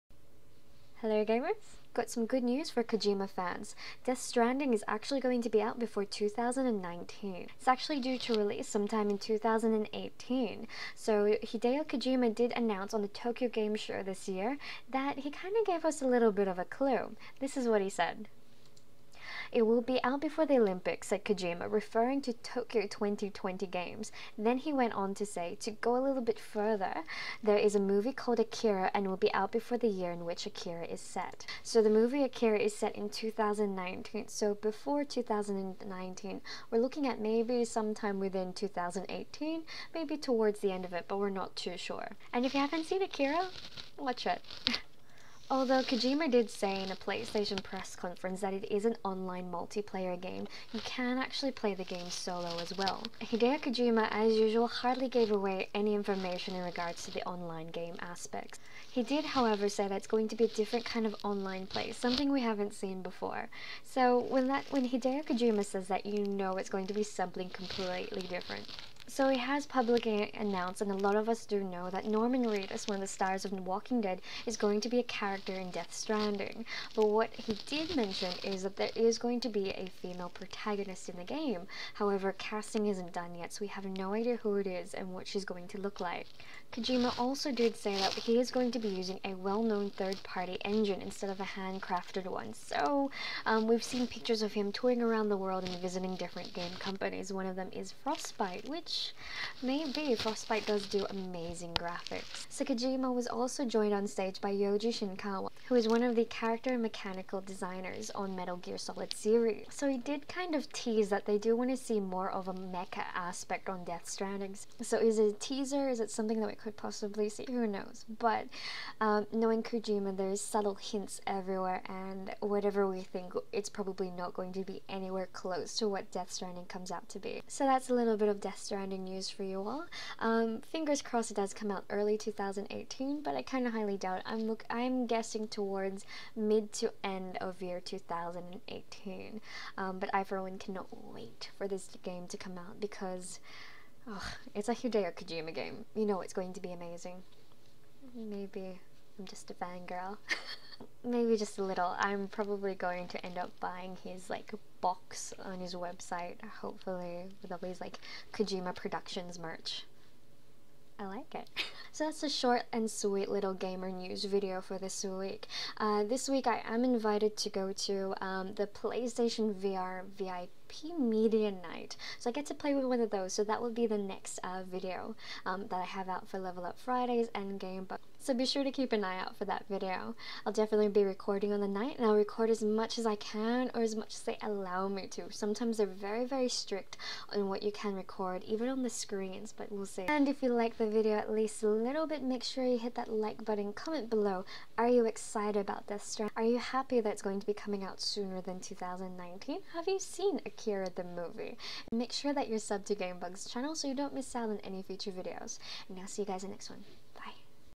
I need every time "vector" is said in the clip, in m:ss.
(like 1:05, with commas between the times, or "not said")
not said.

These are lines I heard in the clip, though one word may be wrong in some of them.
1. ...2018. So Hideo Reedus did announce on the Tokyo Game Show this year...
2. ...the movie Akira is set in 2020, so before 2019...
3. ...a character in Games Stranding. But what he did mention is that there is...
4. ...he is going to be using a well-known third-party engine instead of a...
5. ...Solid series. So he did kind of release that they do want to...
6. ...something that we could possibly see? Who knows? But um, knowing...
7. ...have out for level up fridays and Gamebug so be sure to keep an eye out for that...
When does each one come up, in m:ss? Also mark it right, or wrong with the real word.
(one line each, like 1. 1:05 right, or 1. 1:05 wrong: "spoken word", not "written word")
1. 0:09 wrong: "Kojima", not "Reedus"
2. 0:31 wrong: "2019", not "2020"
3. 1:14 wrong: "Death", not "Games"
4. 1:28 right
5. 1:48 wrong: "tease", not "release"
6. 1:56 right
7. 2:55 right.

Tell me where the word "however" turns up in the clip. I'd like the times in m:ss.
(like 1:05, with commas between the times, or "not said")
0:59, 1:21.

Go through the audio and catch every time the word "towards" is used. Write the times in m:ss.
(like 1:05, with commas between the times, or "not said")
0:40, 2:15.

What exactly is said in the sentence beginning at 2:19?
Um, but I for one cannot wait for this game to come out because oh, it's a Hideo Kojima game.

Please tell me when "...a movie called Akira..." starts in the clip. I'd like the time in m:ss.
0:27.